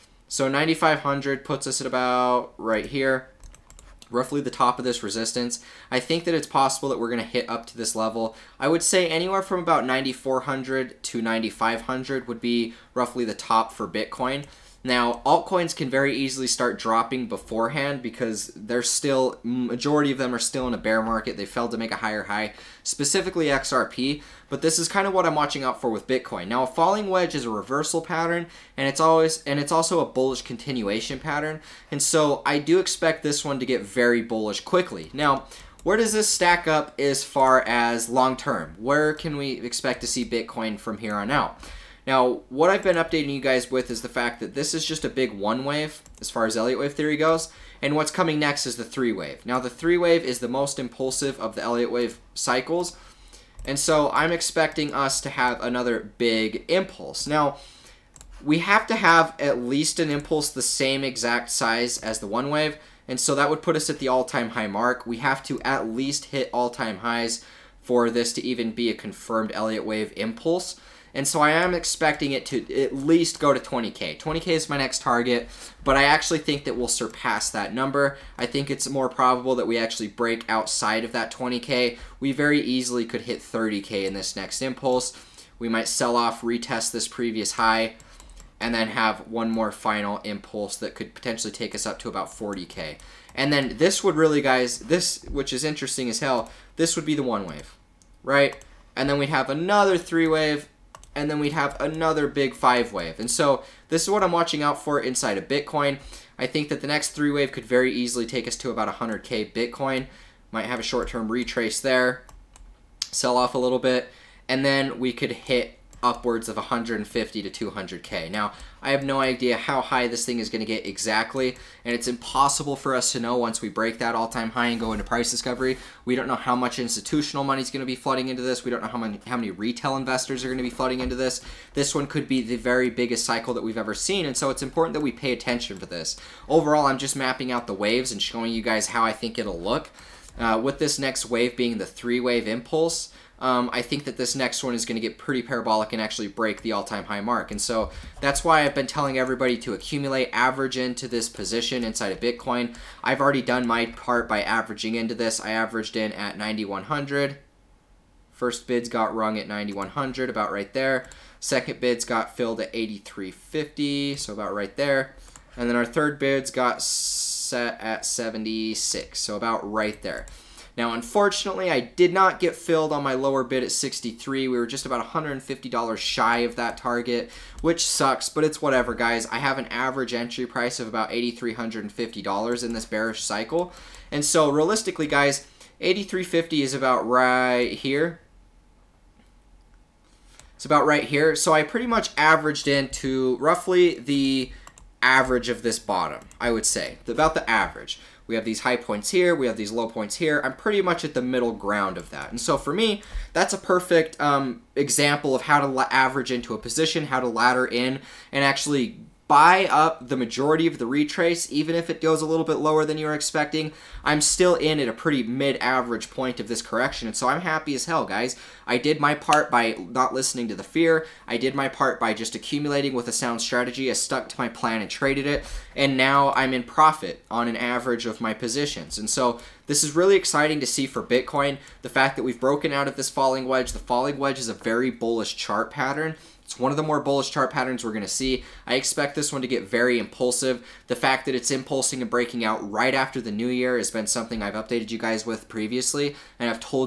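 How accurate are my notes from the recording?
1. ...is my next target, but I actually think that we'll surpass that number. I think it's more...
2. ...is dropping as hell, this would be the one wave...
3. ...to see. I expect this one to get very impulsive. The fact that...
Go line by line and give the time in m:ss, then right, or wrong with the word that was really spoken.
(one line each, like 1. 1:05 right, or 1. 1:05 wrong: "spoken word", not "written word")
1. 1:14 right
2. 1:35 wrong: "interesting", not "dropping"
3. 3:58 right.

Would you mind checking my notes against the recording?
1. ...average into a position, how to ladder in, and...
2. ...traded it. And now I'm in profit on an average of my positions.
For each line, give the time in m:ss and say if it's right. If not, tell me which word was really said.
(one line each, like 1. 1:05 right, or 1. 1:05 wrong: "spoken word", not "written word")
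1. 3:25 right
2. 3:44 right.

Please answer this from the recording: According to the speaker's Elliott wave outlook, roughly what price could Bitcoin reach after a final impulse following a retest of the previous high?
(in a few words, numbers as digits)
40K.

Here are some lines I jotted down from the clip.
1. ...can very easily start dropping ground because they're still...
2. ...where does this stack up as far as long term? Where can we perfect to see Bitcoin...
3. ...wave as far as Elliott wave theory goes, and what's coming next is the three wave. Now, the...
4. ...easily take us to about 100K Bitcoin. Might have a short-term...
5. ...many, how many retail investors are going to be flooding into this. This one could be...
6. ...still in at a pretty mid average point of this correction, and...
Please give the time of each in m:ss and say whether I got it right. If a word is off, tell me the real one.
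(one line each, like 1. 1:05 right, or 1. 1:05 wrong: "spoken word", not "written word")
1. 0:15 wrong: "beforehand", not "ground"
2. 0:35 wrong: "expect", not "perfect"
3. 0:45 right
4. 1:47 right
5. 2:08 right
6. 3:34 right.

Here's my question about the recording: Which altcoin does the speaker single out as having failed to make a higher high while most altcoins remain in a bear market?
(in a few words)
XRP.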